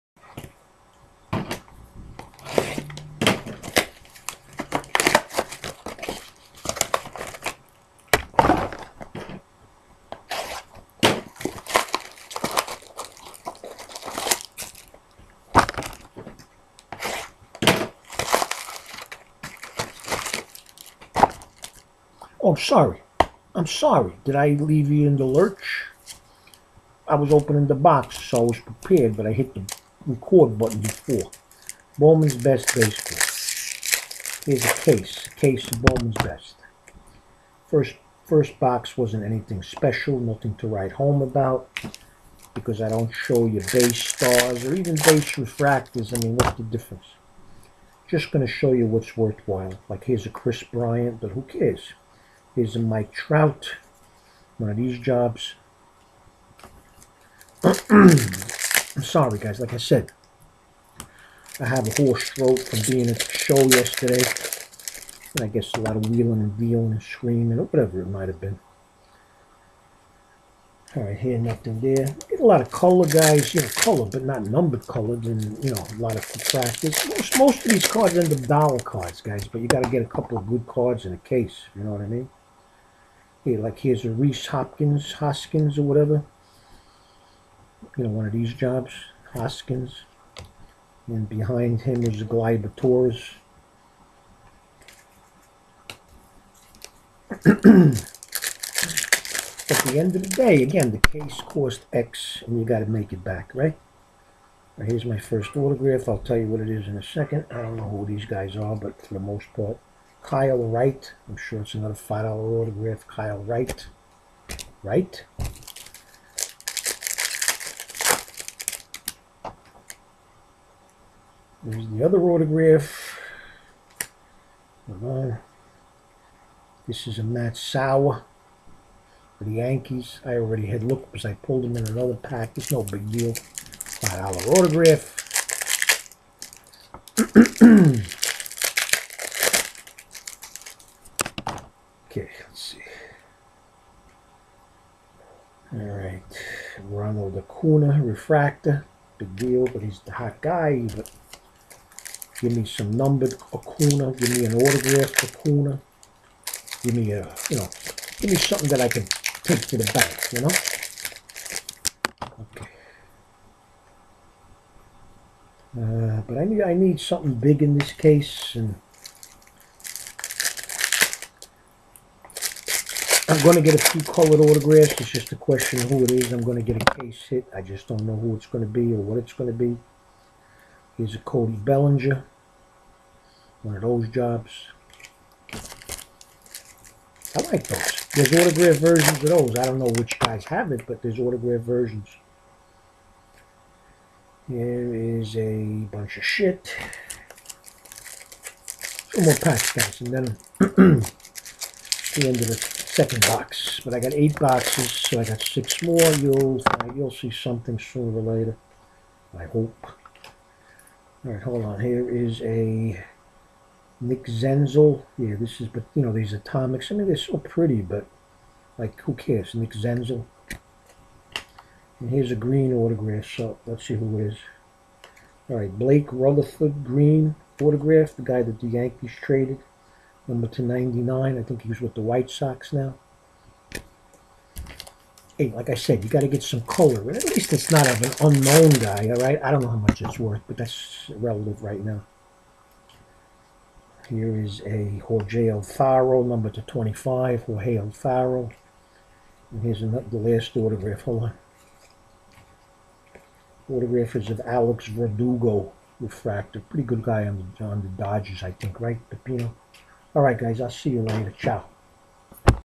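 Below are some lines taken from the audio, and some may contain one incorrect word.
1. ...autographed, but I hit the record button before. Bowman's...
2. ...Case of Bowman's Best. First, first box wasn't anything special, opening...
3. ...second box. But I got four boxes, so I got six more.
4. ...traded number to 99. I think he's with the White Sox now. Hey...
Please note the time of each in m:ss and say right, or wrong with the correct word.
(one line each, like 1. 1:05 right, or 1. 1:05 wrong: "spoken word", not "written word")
1. 0:28 wrong: "prepared", not "autographed"
2. 0:35 wrong: "nothing", not "opening"
3. 3:22 wrong: "eight", not "four"
4. 3:49 right.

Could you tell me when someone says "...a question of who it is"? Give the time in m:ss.
2:55.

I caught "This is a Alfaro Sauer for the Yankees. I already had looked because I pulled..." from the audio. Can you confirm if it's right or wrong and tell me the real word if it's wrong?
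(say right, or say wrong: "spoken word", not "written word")
wrong: "Matt", not "Alfaro".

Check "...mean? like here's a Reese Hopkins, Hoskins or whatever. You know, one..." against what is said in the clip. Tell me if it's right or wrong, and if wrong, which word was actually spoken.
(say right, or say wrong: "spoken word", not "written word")
right.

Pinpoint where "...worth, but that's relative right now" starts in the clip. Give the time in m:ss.
4:00.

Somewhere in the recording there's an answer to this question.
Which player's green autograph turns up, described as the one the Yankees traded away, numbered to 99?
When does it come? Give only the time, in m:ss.
3:45.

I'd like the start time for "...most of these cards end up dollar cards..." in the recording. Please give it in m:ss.
1:17.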